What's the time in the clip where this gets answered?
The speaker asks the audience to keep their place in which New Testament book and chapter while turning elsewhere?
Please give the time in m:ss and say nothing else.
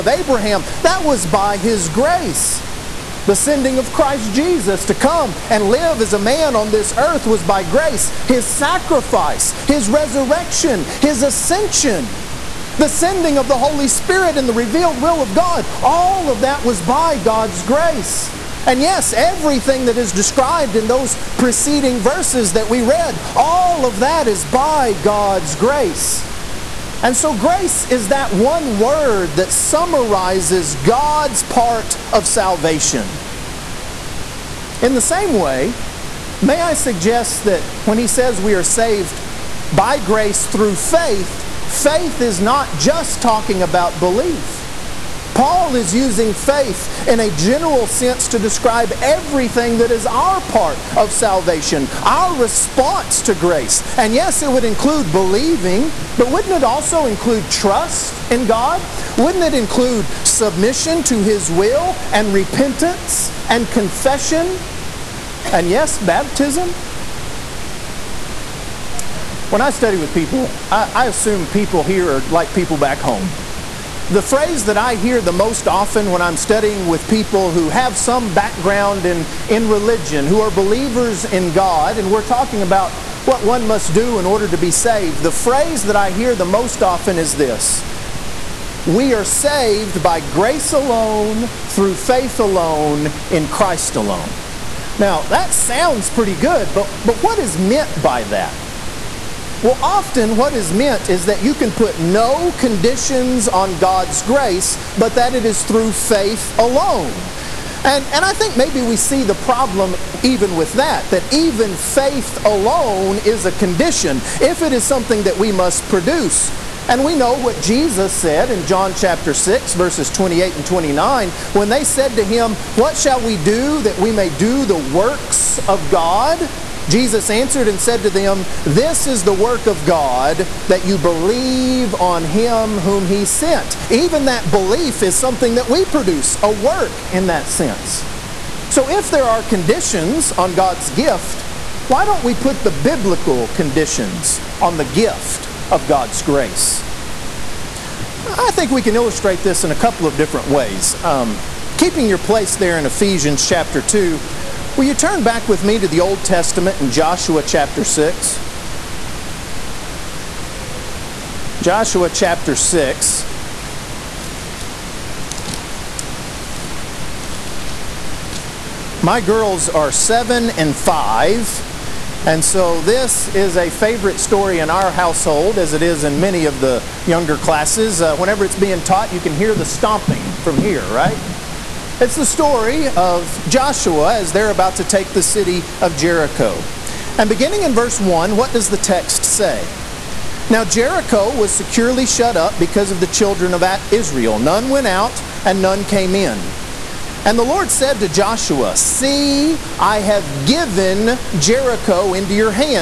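2:32.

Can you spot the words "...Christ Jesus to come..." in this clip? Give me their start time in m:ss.
0:03.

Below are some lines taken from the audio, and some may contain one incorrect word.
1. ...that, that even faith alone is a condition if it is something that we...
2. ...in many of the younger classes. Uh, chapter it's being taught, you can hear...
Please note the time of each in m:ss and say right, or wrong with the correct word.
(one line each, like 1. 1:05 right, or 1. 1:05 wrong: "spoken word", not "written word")
1. 1:50 right
2. 2:56 wrong: "whenever", not "chapter".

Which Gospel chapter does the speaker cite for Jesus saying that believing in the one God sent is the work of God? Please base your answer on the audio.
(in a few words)
John chapter 6.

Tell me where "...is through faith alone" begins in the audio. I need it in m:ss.
1:45.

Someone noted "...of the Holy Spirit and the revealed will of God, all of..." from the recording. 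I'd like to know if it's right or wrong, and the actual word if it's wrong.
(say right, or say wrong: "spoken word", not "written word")
right.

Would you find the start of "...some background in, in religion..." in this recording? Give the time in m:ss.
1:17.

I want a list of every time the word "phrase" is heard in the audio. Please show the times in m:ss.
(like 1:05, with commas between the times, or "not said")
1:14, 1:25.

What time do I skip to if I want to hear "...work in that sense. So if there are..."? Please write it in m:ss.
2:16.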